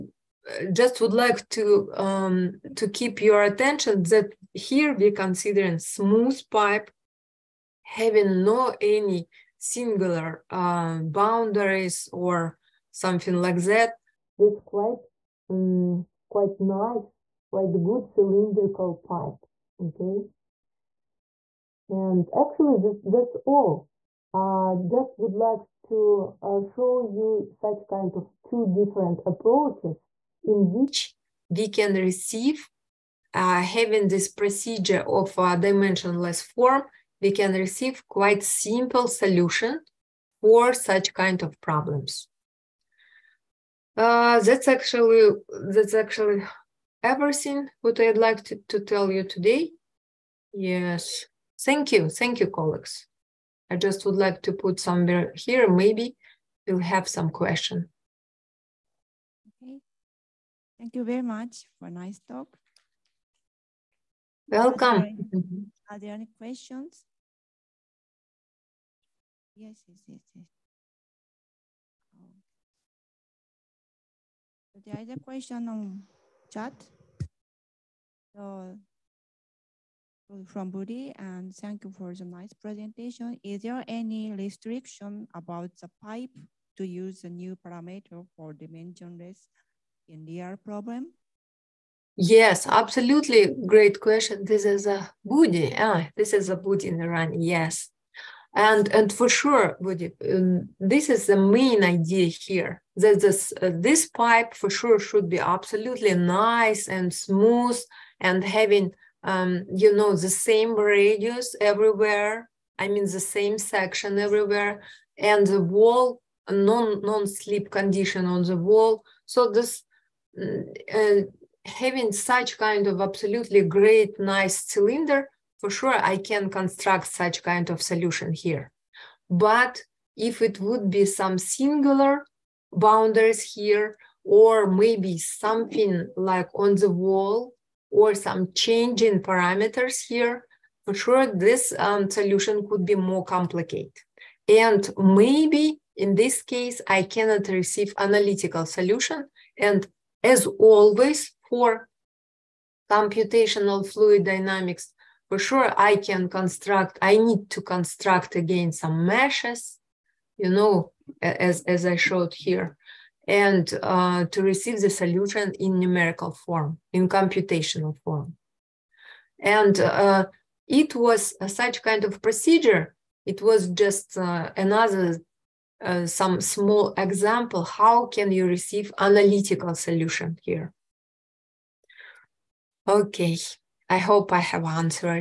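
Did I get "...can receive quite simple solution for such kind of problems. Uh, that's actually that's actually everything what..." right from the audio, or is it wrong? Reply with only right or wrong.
right.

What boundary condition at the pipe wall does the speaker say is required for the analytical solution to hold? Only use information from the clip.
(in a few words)
non-slip condition.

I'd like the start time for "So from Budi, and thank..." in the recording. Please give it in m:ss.
1:18.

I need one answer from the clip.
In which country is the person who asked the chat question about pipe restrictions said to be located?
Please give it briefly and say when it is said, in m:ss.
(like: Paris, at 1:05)
Iran, at 1:37.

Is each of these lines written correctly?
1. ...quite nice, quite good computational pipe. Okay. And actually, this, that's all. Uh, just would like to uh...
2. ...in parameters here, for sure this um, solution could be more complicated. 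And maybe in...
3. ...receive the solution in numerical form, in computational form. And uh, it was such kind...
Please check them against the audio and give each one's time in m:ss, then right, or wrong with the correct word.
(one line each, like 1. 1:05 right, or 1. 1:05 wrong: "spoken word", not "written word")
1. 0:16 wrong: "cylindrical", not "computational"
2. 2:19 right
3. 2:44 right.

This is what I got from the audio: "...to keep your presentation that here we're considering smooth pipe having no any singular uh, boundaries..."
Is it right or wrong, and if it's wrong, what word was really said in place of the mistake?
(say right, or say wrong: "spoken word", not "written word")
wrong: "attention", not "presentation".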